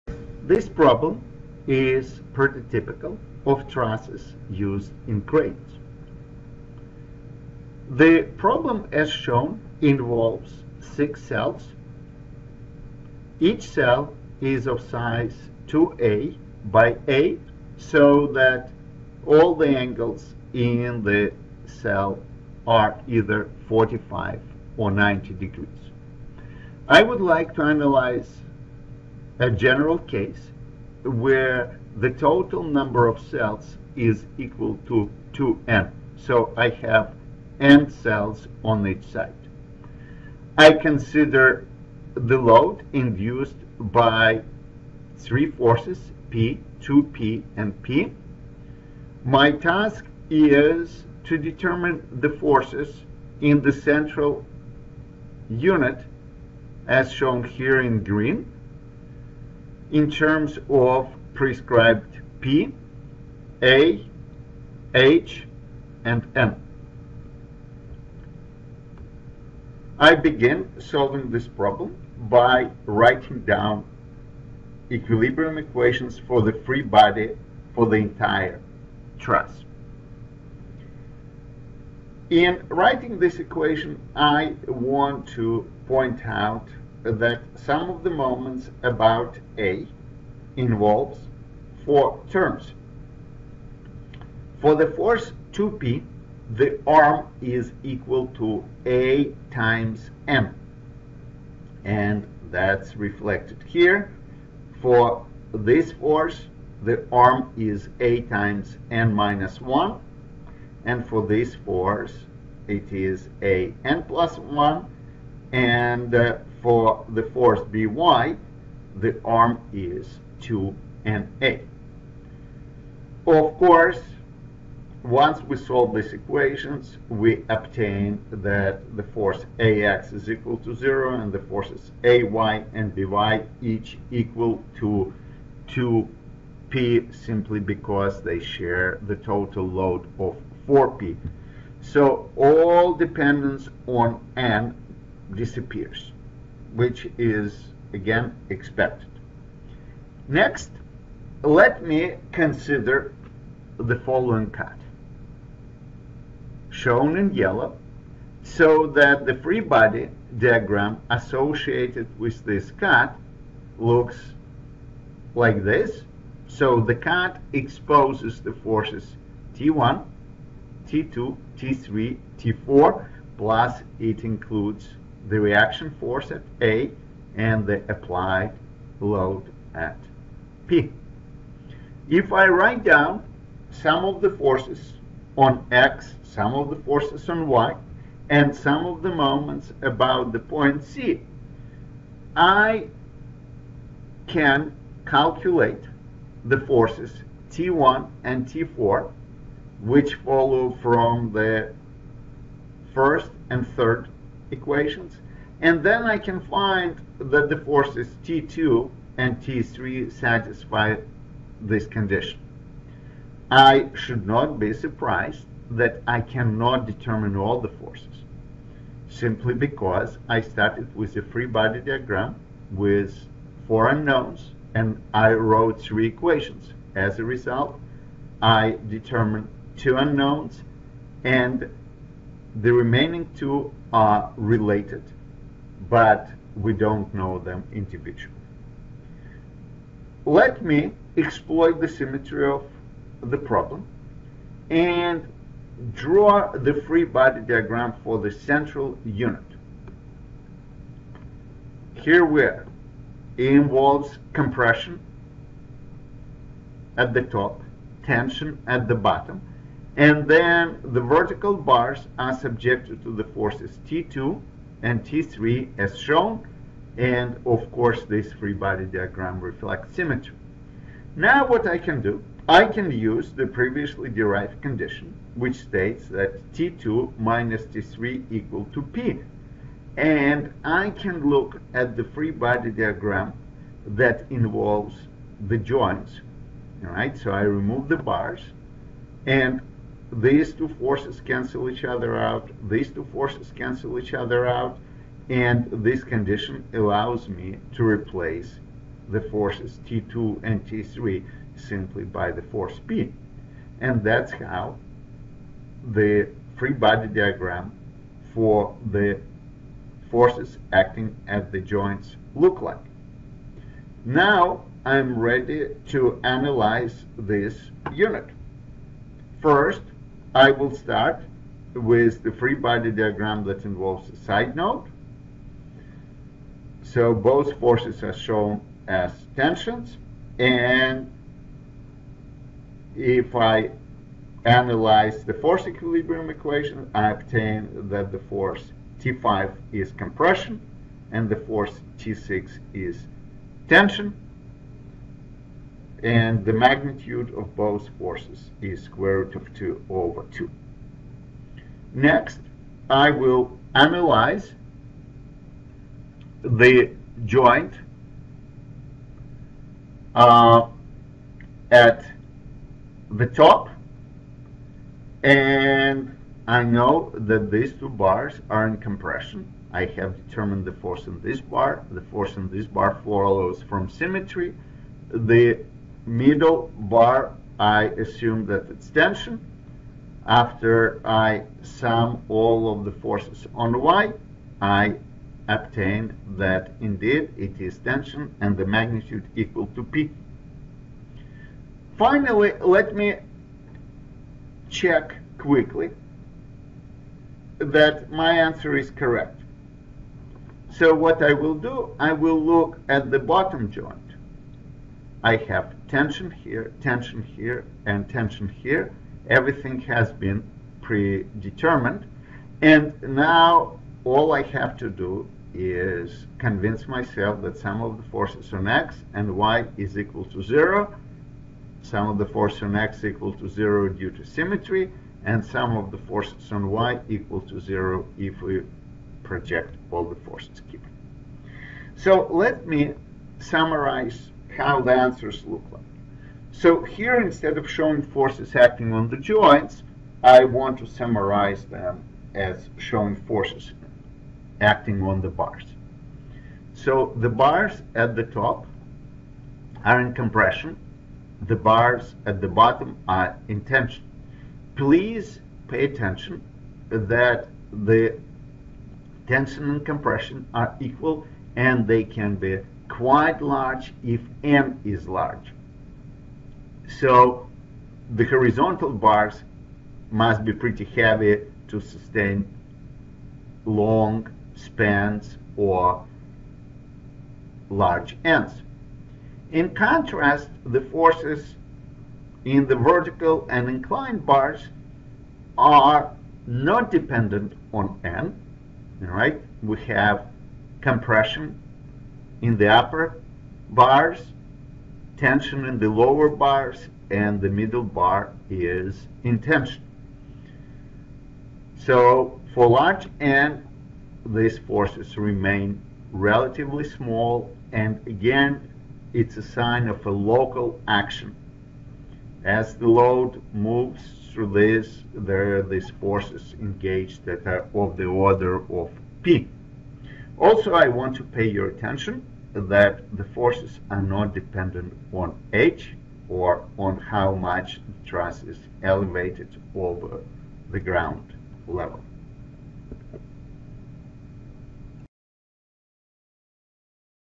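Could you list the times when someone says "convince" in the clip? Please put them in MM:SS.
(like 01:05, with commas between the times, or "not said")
06:56.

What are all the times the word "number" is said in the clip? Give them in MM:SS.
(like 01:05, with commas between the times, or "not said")
00:32.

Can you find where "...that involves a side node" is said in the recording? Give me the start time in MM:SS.
05:23.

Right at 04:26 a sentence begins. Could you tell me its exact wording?
And of course, this free body diagram reflects symmetry.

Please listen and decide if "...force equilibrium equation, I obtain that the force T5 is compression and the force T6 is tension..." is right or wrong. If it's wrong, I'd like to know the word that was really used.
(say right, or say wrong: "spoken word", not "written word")
right.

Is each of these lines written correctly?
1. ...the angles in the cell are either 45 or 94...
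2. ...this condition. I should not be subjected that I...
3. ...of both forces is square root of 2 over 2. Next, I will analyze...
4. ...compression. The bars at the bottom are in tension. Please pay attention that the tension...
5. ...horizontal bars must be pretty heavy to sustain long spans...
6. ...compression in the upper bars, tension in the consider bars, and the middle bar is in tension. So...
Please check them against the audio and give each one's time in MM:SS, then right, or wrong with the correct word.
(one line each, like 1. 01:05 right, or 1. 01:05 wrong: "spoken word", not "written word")
1. 00:19 wrong: "90", not "94"
2. 03:31 wrong: "surprised", not "subjected"
3. 05:47 right
4. 07:30 right
5. 07:48 right
6. 08:10 wrong: "lower", not "consider".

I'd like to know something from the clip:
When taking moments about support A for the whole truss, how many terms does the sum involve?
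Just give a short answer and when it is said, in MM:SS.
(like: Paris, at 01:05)
4, at 01:31.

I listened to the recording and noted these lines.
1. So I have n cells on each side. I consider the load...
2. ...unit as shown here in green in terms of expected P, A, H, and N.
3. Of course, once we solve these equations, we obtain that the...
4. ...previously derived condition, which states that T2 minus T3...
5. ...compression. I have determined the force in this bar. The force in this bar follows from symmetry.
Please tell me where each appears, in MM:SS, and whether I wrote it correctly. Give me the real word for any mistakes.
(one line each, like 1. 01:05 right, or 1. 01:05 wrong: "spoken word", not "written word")
1. 00:36 right
2. 00:55 wrong: "prescribed", not "expected"
3. 02:03 right
4. 04:33 right
5. 06:08 right.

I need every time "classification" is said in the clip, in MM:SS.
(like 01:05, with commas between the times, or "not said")
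not said.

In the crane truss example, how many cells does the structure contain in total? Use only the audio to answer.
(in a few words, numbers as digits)
6.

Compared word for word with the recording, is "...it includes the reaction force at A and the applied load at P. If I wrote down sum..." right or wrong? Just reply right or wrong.
wrong.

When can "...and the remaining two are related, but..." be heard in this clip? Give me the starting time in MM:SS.
03:51.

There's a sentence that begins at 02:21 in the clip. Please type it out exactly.
So all dependence on n disappears which is again expected.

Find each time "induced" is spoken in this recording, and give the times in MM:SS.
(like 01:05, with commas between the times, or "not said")
00:42.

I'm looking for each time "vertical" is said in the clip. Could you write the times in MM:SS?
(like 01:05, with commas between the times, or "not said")
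04:21, 08:02.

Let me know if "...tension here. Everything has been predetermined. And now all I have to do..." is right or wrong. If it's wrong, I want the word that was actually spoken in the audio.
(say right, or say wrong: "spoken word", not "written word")
right.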